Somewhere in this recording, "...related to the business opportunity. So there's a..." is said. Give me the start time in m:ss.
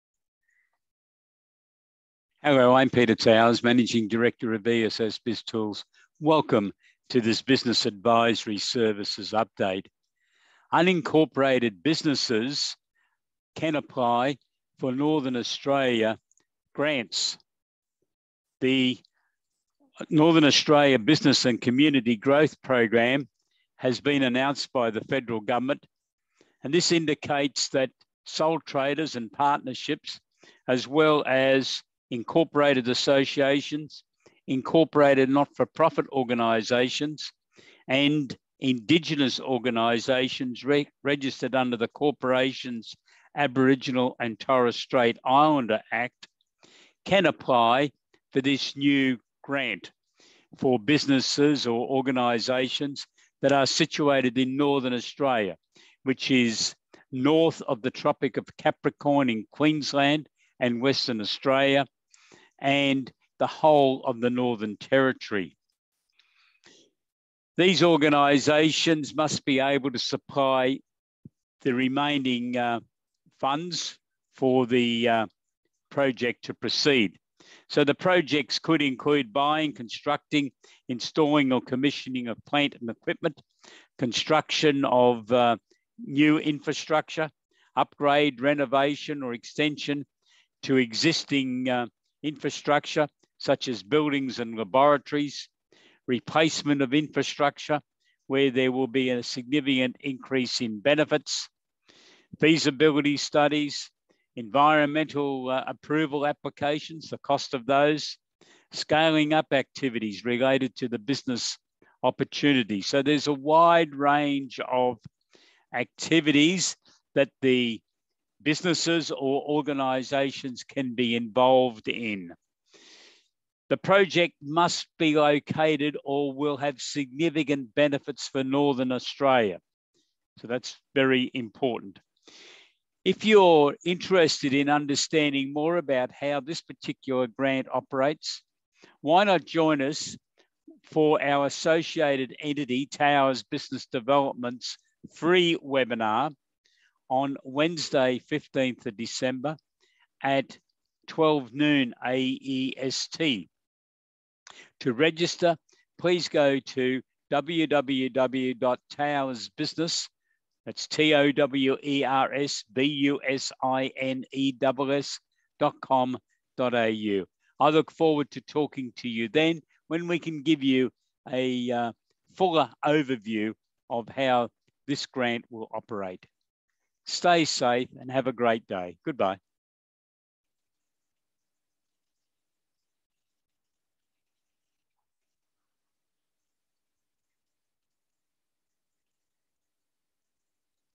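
1:50.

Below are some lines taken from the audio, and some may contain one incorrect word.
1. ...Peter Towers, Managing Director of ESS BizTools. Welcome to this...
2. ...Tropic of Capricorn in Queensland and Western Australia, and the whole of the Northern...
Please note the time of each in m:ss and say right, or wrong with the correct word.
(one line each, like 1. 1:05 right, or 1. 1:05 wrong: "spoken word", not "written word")
1. 0:02 right
2. 0:57 right.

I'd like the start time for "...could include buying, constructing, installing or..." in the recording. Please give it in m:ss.
1:18.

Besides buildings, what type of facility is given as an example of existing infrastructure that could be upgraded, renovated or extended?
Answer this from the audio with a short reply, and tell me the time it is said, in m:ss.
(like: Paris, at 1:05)
Laboratories, at 1:34.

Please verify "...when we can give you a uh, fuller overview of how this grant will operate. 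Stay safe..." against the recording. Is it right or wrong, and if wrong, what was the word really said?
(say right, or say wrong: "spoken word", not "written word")
right.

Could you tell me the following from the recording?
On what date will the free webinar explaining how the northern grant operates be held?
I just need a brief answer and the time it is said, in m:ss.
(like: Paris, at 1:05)
Wednesday, 15 December, at 2:27.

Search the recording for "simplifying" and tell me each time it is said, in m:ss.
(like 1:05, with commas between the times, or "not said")
not said.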